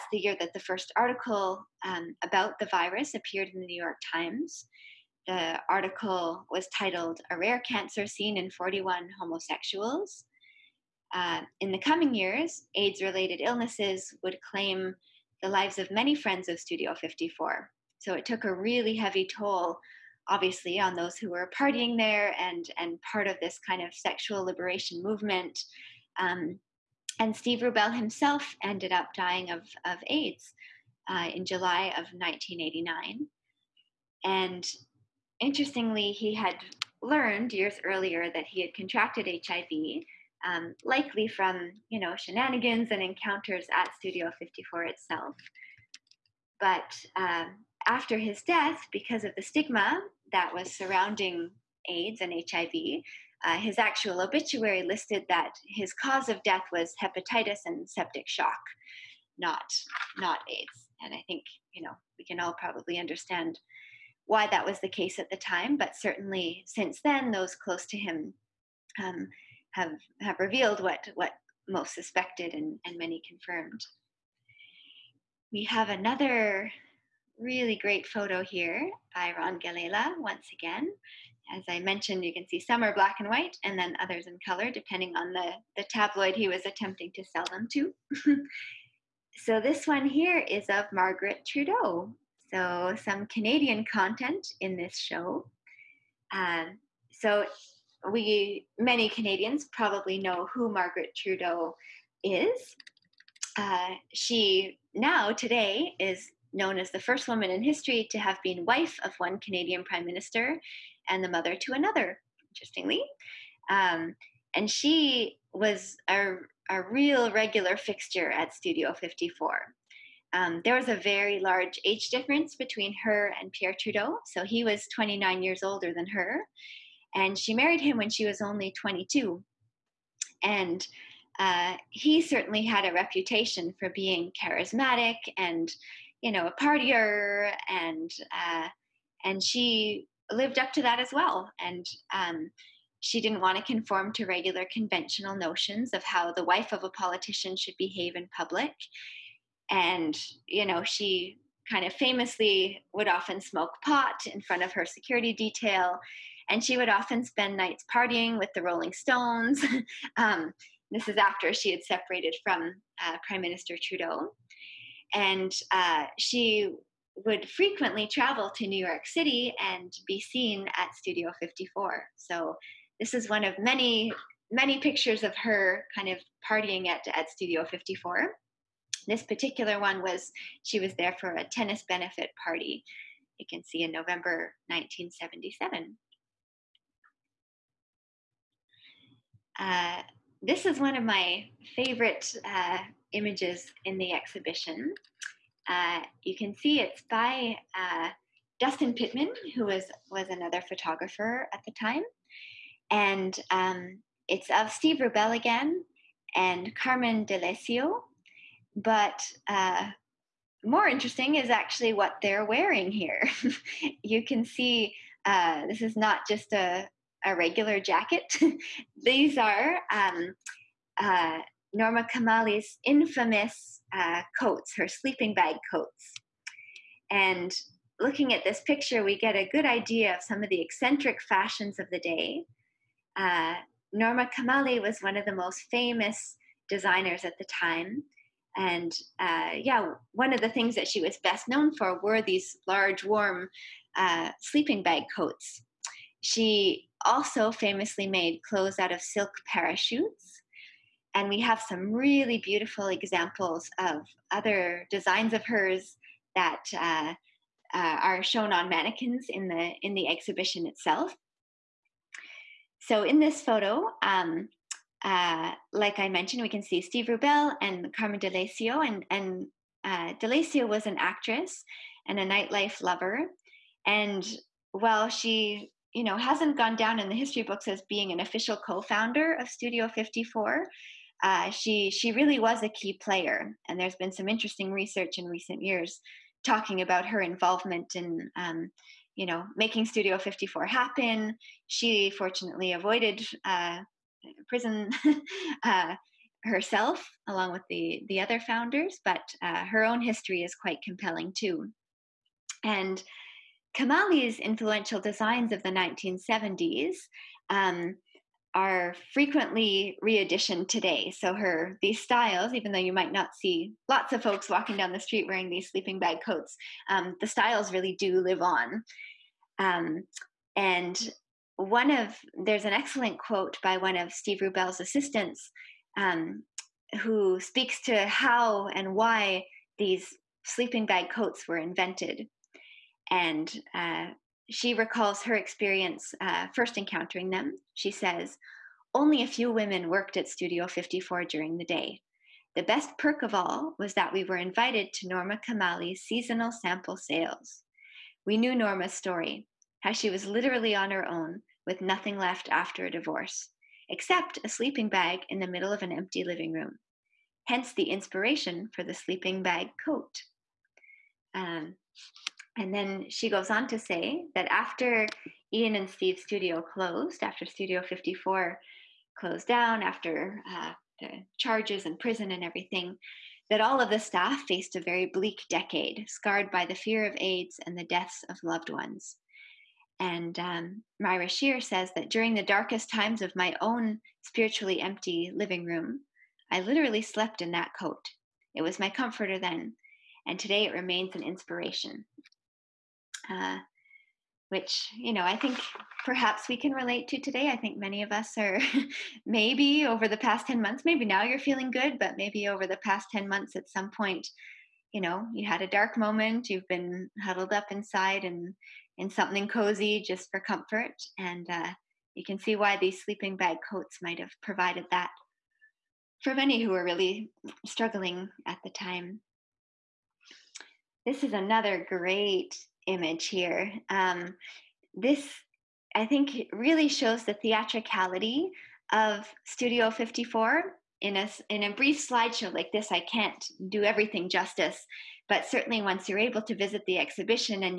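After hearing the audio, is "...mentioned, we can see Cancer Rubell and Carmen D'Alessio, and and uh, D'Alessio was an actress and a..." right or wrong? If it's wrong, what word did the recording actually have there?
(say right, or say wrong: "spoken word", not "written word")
wrong: "Steve", not "Cancer".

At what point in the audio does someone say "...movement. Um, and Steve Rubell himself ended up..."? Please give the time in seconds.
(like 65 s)
25 s.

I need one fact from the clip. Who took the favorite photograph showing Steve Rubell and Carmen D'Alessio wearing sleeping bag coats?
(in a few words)
Dustin Pittman.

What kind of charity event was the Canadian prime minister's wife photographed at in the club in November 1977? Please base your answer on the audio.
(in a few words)
Tennis benefit party.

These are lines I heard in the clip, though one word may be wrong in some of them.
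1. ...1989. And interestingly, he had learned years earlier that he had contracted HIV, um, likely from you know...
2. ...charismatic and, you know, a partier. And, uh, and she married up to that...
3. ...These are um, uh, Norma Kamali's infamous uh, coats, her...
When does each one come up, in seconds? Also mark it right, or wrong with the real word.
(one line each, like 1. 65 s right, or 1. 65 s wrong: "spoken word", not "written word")
1. 32 s right
2. 134 s wrong: "lived", not "married"
3. 219 s right.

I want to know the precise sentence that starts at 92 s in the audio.
So some Canadian content in this show.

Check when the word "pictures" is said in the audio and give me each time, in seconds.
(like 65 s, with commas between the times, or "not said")
174 s, 228 s.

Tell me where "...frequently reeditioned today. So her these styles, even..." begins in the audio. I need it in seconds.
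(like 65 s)
309 s.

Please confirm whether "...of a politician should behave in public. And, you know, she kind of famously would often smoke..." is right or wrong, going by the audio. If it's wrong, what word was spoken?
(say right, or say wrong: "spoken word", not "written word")
right.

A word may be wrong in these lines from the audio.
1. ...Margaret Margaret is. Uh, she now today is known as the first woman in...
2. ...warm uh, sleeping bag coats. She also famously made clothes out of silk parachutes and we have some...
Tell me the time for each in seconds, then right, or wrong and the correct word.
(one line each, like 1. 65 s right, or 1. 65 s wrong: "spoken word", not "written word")
1. 100 s wrong: "Trudeau", not "Margaret"
2. 243 s right.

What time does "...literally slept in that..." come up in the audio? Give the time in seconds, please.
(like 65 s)
386 s.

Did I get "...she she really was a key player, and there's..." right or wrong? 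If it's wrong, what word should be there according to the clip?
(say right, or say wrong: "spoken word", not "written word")
right.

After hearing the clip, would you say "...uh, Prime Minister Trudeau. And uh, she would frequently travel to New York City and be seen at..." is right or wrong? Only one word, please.
right.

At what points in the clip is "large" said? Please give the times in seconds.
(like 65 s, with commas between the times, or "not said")
121 s, 242 s.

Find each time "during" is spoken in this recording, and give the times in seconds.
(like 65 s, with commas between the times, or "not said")
341 s, 382 s.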